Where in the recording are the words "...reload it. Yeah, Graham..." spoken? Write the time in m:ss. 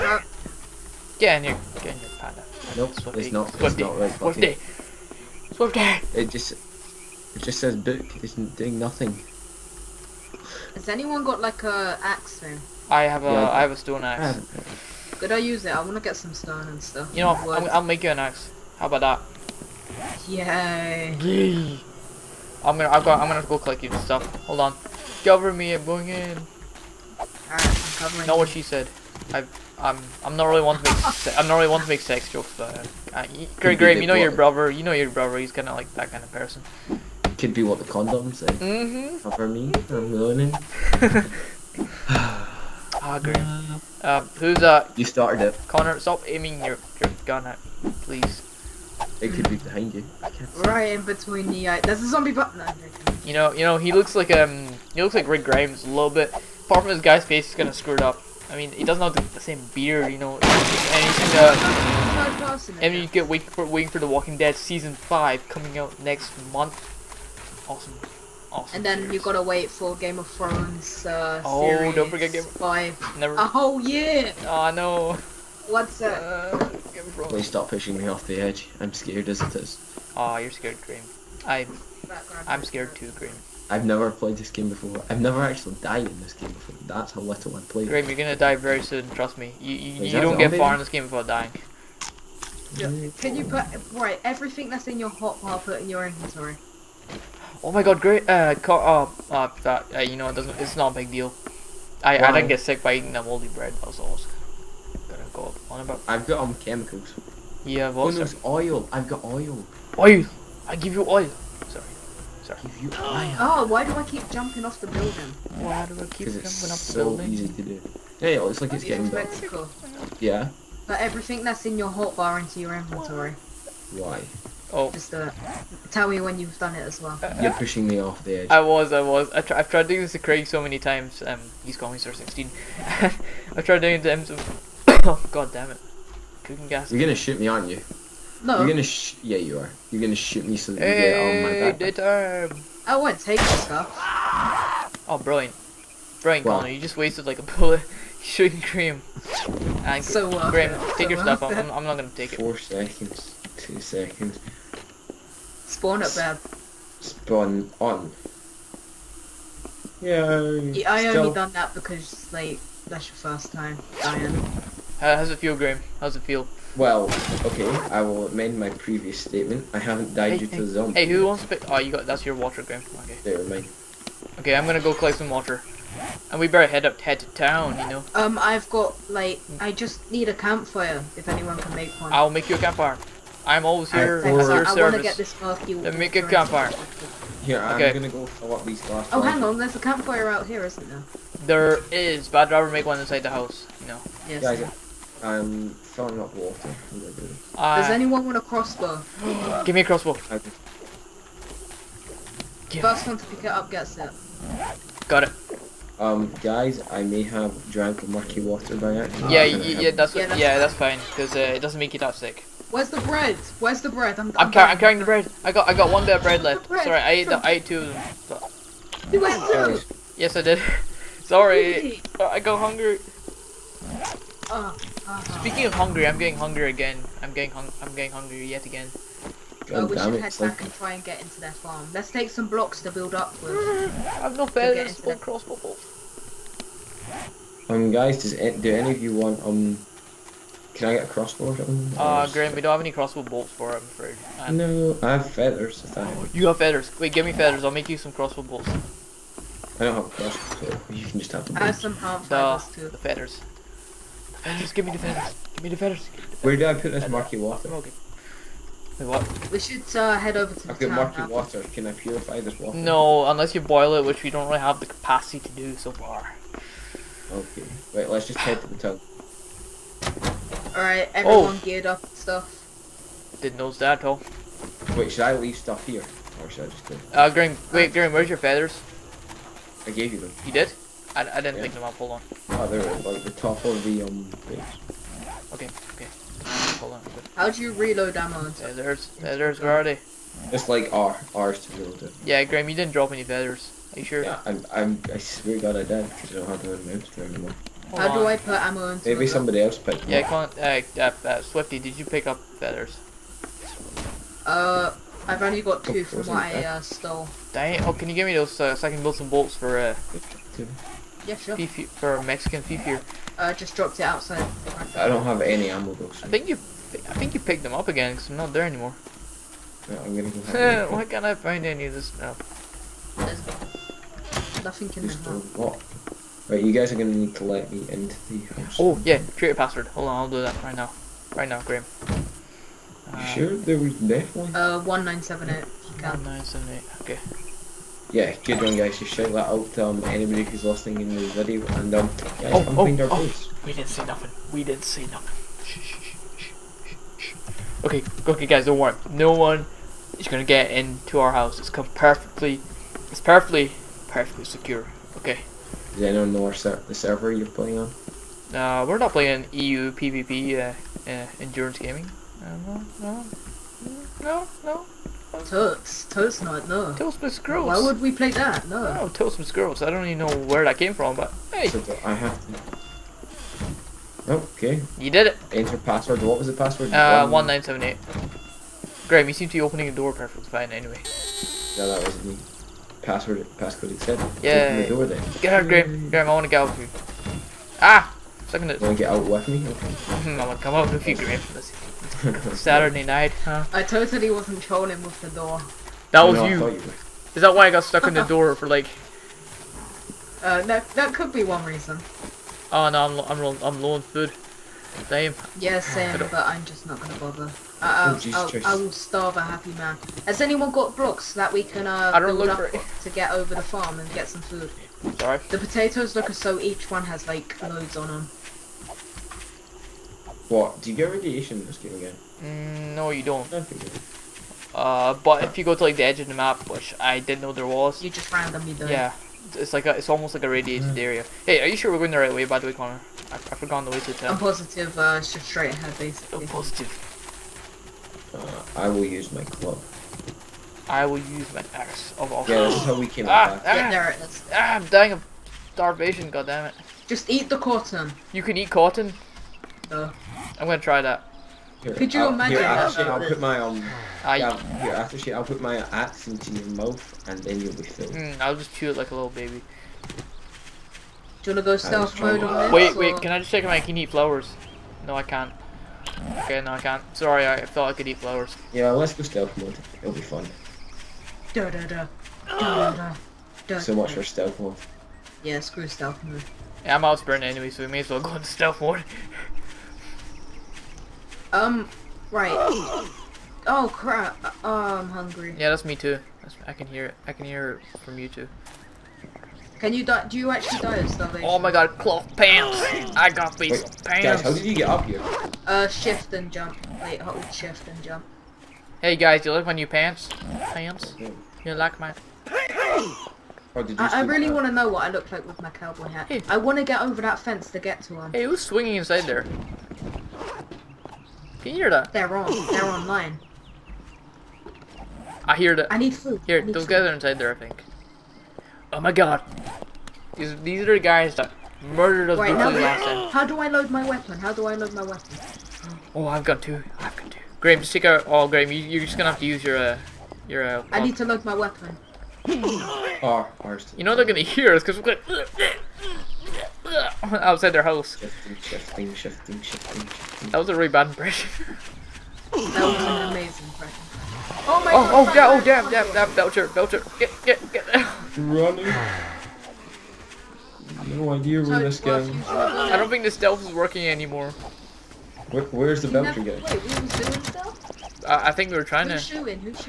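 4:51.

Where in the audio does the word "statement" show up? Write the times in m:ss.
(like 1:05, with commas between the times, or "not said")
2:49.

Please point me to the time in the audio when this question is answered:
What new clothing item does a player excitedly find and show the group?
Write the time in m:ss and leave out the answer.
8:11.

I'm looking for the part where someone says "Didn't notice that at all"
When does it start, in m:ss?
4:33.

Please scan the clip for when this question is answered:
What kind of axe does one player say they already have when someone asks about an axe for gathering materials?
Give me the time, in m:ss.
0:13.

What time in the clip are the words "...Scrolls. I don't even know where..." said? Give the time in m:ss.
6:09.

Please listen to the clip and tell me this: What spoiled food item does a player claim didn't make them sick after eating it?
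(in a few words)
moldy bread.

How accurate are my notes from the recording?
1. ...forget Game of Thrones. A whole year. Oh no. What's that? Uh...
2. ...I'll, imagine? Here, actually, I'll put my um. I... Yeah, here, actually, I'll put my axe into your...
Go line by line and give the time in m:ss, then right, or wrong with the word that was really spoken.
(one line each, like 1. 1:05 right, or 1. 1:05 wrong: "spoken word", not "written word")
1. 1:12 right
2. 7:32 right.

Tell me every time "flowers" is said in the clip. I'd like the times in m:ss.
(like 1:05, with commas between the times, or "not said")
7:44, 7:48.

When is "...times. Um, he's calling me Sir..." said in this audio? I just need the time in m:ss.
2:10.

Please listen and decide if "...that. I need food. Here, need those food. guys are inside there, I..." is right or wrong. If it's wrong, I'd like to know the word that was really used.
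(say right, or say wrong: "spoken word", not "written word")
right.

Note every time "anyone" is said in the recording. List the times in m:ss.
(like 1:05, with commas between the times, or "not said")
0:10, 3:01, 3:17, 5:56, 6:50.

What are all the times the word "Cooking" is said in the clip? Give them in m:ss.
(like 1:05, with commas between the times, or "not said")
2:16.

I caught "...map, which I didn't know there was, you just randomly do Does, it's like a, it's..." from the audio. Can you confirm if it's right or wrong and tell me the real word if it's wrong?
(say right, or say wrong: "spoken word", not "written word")
wrong: "Yeah", not "Does".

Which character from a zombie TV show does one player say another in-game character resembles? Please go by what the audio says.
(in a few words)
Rick Grimes.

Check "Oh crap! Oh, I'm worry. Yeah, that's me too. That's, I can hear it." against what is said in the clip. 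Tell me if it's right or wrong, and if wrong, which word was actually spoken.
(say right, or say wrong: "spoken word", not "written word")
wrong: "hungry", not "worry".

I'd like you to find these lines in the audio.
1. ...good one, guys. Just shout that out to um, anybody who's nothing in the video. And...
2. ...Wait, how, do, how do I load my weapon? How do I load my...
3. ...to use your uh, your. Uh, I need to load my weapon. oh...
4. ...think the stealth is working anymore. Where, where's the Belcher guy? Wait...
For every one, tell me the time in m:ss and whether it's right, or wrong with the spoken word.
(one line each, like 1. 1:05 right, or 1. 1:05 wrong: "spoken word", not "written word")
1. 5:38 wrong: "listening", not "nothing"
2. 8:42 right
3. 8:49 right
4. 9:13 right.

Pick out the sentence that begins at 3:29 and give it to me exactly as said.
Yeah, yeah, that's yeah, that's, yeah, that's fine.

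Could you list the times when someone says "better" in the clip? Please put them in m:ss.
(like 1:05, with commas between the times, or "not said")
1:59, 2:56.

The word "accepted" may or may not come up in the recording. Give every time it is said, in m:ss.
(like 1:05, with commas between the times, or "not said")
6:23.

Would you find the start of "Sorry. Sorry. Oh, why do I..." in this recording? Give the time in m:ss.
1:51.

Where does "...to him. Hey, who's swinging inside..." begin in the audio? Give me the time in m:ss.
8:28.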